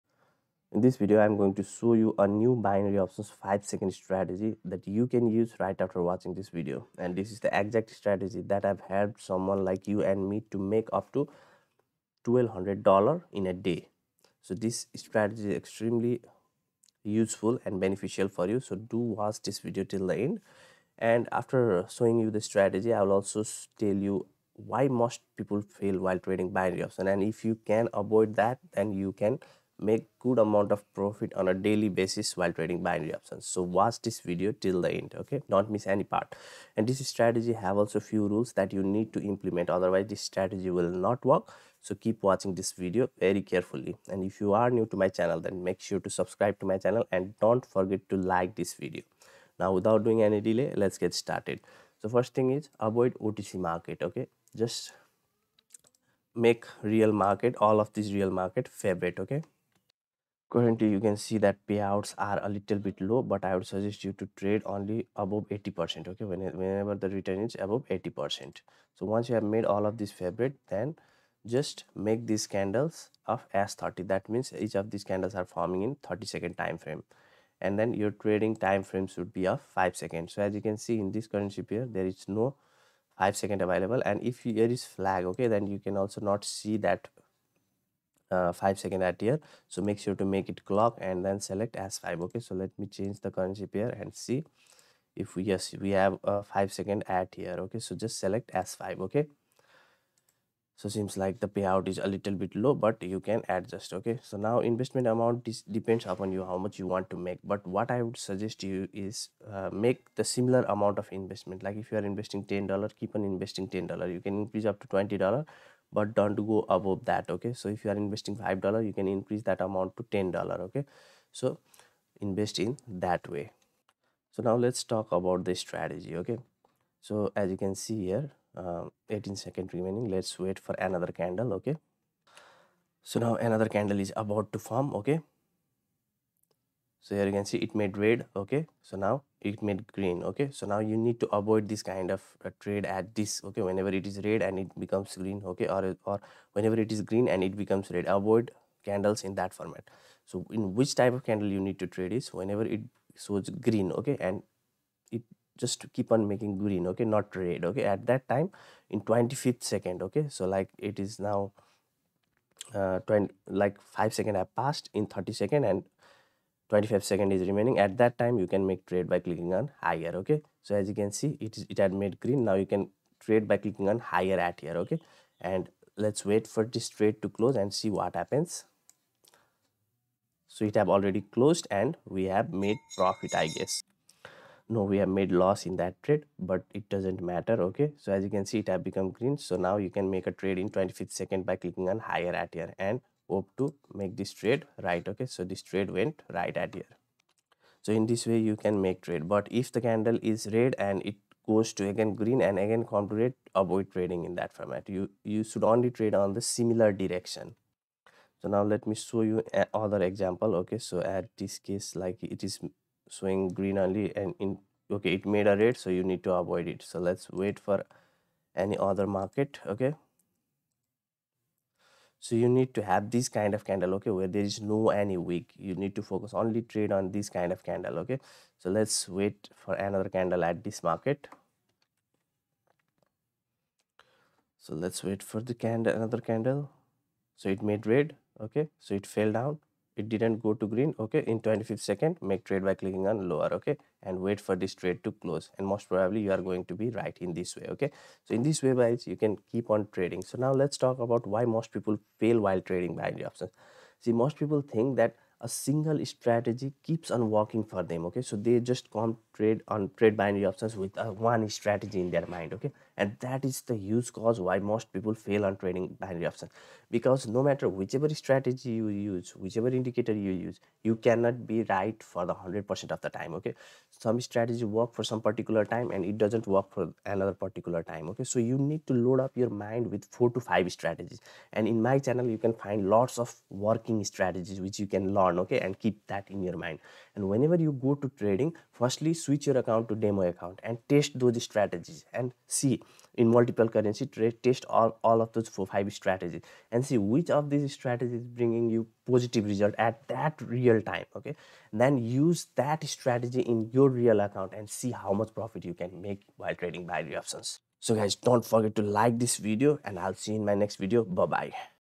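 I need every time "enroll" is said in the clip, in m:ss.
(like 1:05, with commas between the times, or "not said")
not said.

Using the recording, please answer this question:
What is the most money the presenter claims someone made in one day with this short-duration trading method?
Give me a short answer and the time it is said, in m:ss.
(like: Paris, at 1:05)
$1200, at 0:12.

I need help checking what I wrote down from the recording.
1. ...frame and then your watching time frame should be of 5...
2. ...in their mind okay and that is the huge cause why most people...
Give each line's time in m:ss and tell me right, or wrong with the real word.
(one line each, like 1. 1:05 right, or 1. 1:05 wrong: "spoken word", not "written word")
1. 1:16 wrong: "trading", not "watching"
2. 4:22 right.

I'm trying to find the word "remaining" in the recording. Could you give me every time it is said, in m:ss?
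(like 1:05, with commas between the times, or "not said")
2:09, 2:47.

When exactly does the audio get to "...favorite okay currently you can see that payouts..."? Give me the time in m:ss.
0:58.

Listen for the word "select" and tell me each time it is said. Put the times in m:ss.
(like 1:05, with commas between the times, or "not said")
1:31, 1:38.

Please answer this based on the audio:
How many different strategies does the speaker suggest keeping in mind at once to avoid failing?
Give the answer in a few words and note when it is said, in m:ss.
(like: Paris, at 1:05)
4 to 5, at 4:40.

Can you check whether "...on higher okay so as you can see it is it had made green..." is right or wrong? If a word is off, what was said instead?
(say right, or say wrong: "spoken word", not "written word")
right.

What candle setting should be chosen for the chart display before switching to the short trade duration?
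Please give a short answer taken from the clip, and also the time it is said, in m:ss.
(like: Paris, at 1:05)
S30, at 1:13.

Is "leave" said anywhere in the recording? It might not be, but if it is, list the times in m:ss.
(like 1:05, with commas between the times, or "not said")
not said.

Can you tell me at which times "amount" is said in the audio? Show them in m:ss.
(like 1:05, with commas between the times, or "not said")
0:30, 1:45, 1:50, 1:59.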